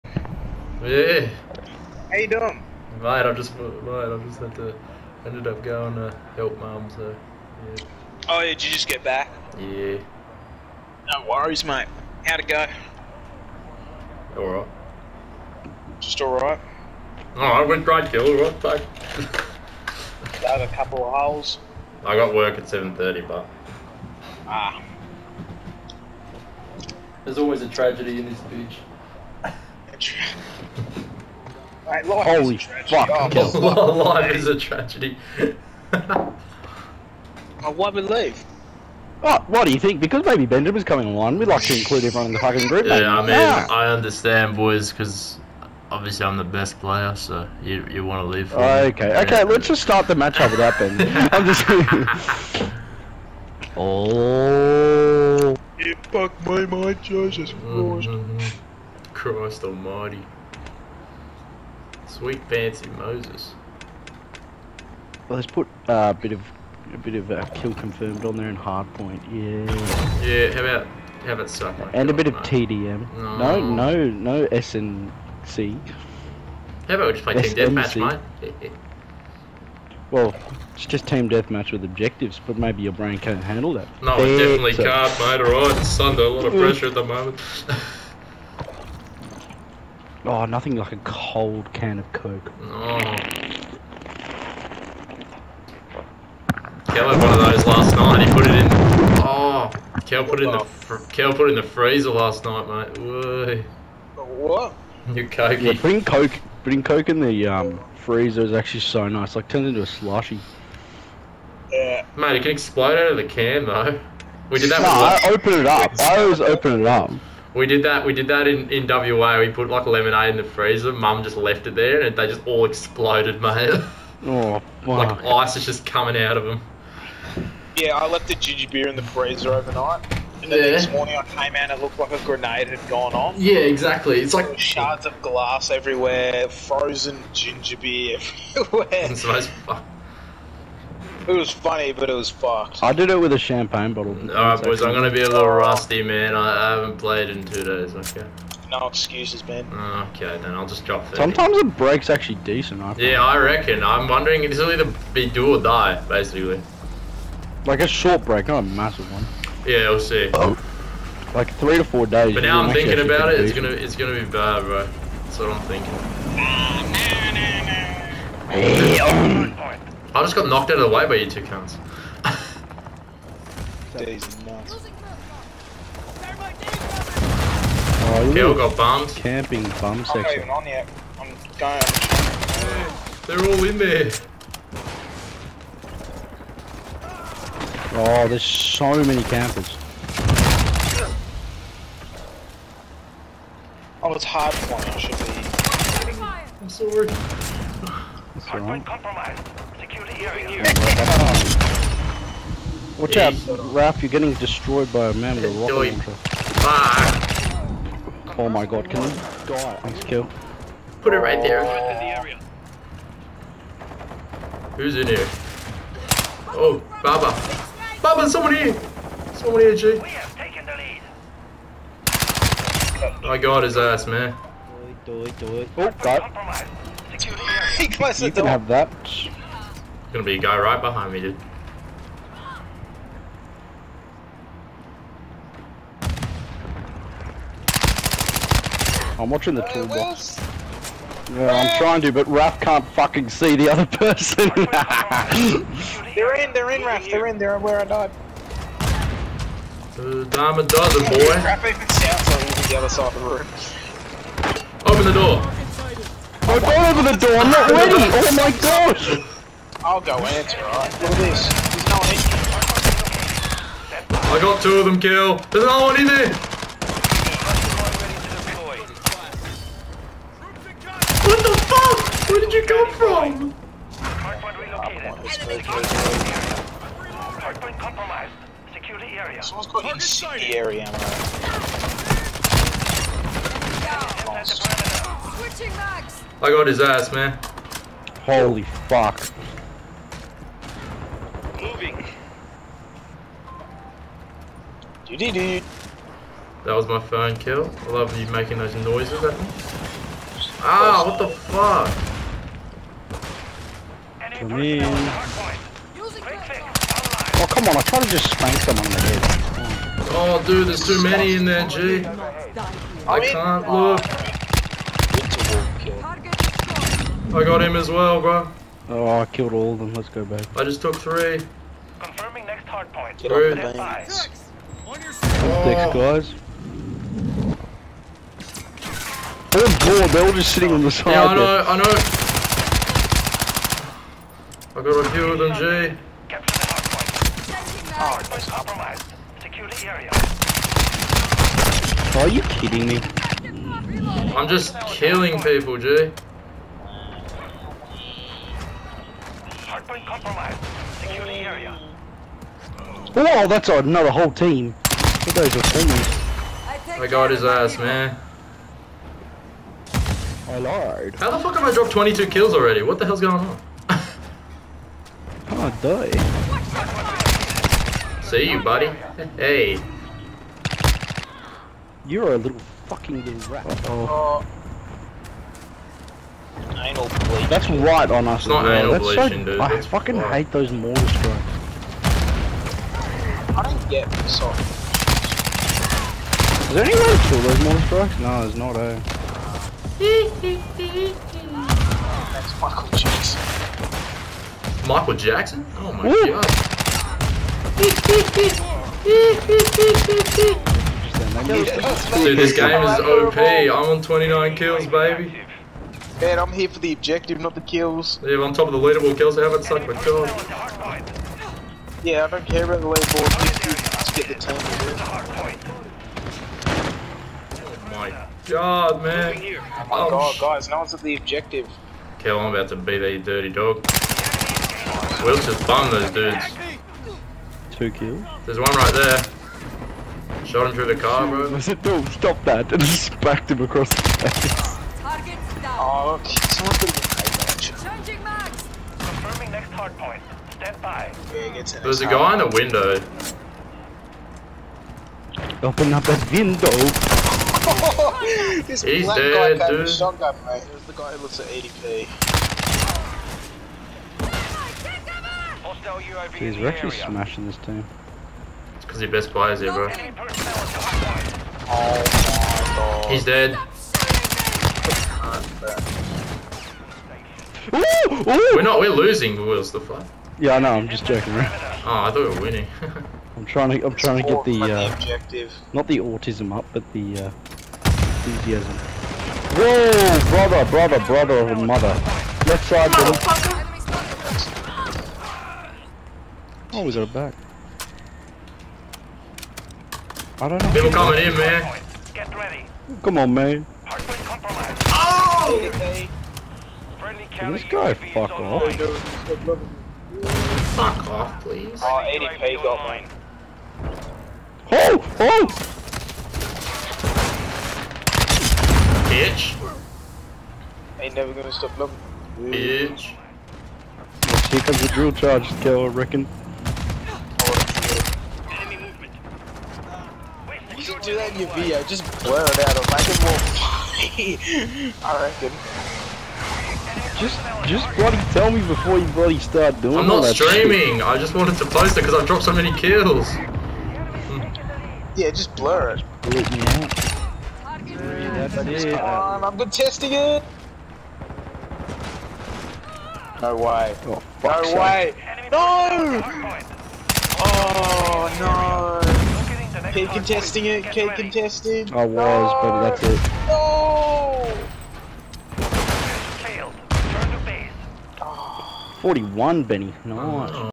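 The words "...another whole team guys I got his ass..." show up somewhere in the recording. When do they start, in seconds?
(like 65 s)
353 s.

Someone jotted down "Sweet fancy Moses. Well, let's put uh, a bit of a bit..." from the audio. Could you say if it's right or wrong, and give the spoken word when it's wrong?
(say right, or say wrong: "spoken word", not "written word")
right.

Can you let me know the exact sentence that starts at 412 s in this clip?
Yeah, I don't care about the leaderboard.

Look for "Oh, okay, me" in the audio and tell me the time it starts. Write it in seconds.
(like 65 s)
48 s.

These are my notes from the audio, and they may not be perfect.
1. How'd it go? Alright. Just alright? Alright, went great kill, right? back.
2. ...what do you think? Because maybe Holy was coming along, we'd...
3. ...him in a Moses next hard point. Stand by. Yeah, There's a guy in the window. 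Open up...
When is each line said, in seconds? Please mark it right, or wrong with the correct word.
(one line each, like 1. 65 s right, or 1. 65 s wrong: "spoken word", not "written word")
1. 12 s right
2. 39 s wrong: "Bender", not "Holy"
3. 436 s wrong: "Confirming", not "Moses".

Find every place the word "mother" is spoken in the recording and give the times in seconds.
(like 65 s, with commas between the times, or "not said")
481 s.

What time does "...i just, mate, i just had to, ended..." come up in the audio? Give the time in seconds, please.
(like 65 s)
3 s.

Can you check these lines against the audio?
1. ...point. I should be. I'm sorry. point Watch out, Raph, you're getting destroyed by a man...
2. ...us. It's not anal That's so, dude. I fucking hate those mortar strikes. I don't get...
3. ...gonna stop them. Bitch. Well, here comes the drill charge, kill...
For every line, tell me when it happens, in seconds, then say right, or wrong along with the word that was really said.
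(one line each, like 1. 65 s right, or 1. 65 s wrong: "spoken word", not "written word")
1. 194 s right
2. 378 s right
3. 511 s right.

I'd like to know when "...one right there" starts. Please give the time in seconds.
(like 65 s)
428 s.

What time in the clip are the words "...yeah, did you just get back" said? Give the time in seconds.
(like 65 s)
8 s.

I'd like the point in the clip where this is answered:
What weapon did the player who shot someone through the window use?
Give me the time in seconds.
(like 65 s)
449 s.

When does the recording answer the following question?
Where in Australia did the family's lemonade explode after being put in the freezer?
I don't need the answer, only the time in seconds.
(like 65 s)
118 s.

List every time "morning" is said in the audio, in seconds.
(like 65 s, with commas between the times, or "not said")
130 s.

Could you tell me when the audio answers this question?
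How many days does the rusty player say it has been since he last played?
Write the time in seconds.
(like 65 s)
147 s.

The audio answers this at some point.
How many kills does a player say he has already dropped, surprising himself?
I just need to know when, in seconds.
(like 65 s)
361 s.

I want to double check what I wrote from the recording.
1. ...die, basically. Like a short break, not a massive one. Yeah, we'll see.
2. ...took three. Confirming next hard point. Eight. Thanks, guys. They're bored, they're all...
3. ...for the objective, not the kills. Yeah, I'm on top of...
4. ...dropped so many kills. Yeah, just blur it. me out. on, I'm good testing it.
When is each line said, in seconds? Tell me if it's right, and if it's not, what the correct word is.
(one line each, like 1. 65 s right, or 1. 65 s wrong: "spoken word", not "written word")
1. 155 s right
2. 320 s wrong: "Three", not "Eight"
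3. 406 s right
4. 532 s right.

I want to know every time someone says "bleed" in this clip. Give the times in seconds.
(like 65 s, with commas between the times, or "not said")
377 s.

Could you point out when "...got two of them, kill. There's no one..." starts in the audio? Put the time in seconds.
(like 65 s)
264 s.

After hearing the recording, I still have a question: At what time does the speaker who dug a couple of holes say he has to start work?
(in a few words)
7:30.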